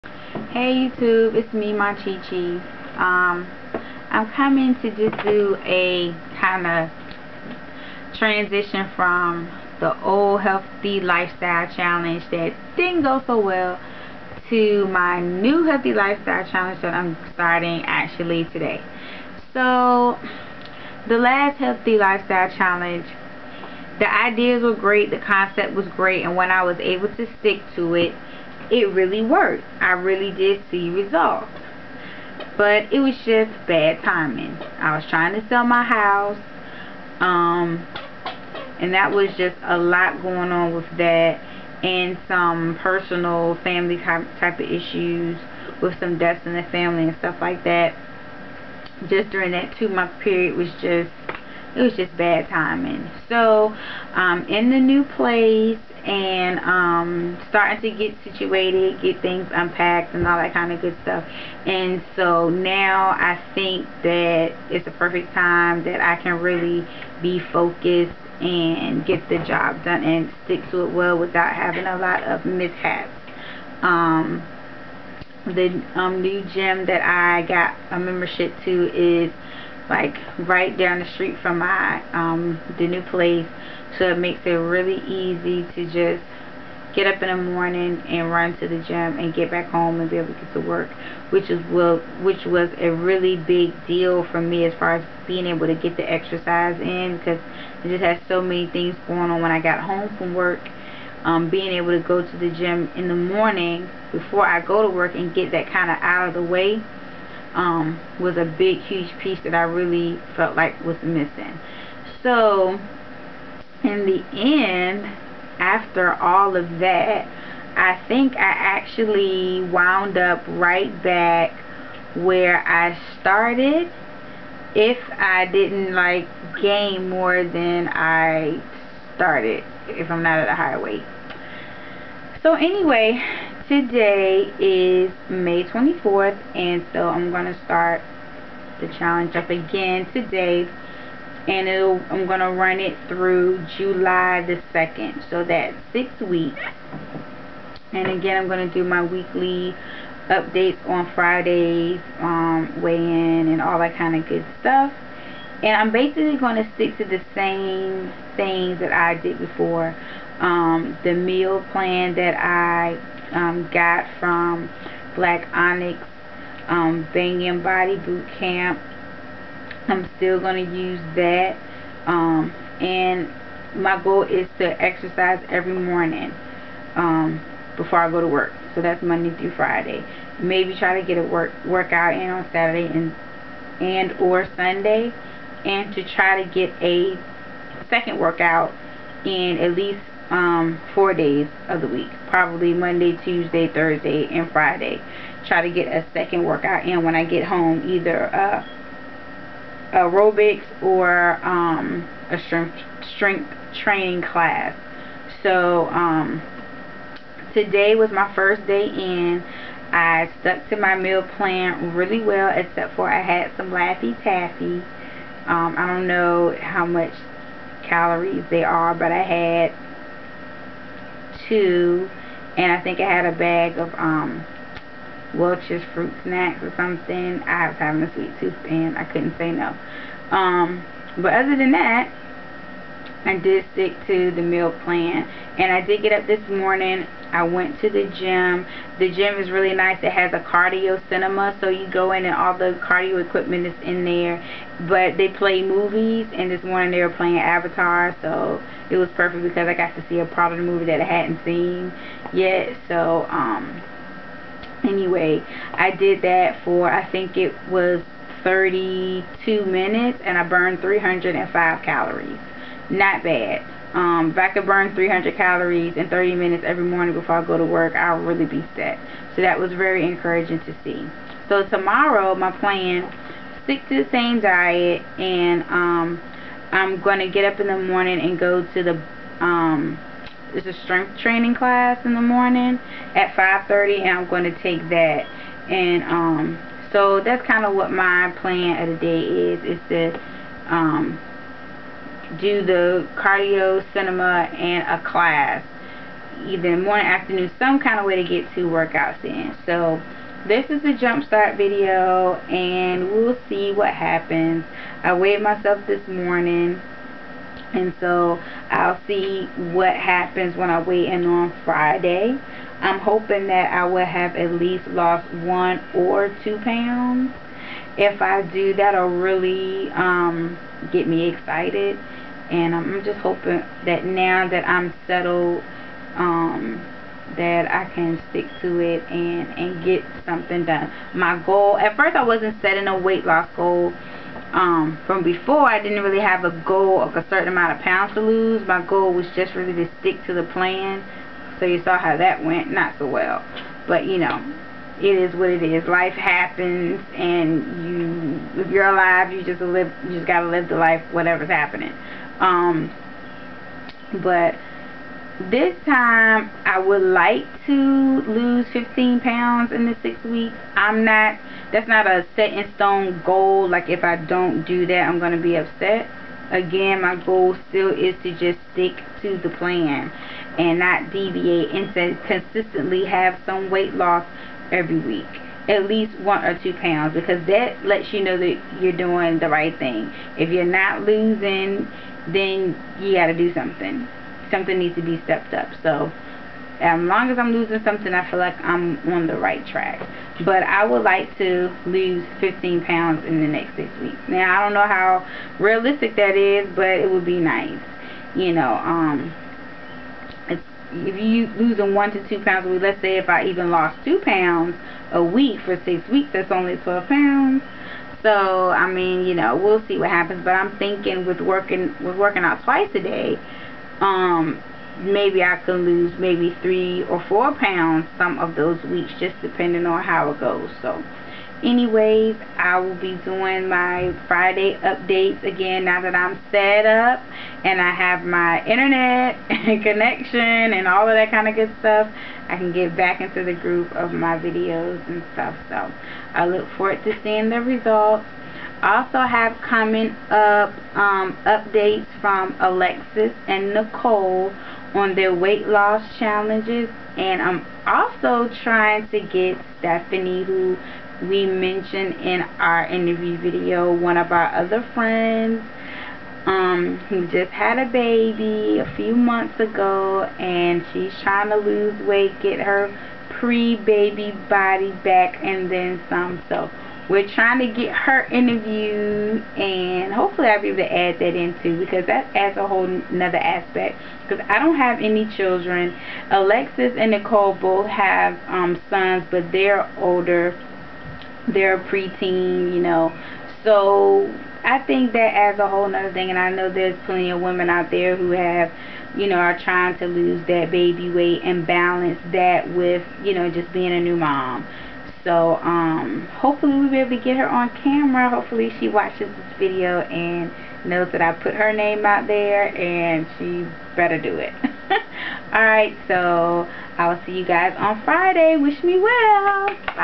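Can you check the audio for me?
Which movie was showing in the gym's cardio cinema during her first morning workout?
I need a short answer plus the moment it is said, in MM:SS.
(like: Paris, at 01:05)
Avatar, at 04:07.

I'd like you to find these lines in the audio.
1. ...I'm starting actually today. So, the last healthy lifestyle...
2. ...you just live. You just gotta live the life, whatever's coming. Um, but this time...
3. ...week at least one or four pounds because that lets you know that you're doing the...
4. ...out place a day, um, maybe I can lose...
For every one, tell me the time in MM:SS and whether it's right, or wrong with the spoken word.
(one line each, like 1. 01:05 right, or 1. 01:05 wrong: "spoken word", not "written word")
1. 00:16 right
2. 05:49 wrong: "happening", not "coming"
3. 06:14 wrong: "two", not "four"
4. 06:52 wrong: "twice", not "place".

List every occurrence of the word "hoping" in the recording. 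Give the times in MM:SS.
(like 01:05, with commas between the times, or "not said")
05:12, 05:23.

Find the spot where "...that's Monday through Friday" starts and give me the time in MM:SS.
02:58.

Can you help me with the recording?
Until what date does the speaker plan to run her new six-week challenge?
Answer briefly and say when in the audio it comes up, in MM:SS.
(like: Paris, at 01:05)
July 2nd, at 02:23.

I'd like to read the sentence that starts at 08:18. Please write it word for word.
Hopefully she watches this video and knows that I put her name out there and she better do it.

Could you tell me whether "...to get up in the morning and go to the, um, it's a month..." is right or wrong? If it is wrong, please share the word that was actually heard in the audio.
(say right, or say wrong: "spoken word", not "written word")
wrong: "strength", not "month".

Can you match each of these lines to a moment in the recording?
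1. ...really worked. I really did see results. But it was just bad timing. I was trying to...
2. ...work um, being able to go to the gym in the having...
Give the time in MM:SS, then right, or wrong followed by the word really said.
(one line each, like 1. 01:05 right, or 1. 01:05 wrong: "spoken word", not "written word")
1. 00:28 right
2. 01:40 wrong: "morning", not "having".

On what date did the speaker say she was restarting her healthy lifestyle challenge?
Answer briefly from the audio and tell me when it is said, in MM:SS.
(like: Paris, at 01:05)
May 24th, at 02:15.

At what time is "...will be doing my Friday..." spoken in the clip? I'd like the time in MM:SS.
07:02.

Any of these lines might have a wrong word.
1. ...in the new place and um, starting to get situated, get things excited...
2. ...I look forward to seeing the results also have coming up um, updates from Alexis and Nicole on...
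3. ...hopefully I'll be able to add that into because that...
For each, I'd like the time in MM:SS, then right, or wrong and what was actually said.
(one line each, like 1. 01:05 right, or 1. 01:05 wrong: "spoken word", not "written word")
1. 00:54 wrong: "unpacked", not "excited"
2. 07:16 right
3. 07:50 right.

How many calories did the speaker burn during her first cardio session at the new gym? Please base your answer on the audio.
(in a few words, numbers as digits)
305.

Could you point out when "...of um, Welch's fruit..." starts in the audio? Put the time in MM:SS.
03:43.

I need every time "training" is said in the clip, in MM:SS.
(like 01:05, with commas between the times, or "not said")
03:23, 04:41.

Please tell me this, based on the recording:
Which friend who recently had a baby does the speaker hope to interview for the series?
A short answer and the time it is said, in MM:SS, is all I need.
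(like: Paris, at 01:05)
Stephanie, at 07:29.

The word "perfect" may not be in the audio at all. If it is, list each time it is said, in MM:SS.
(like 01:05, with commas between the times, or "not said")
01:04, 04:09.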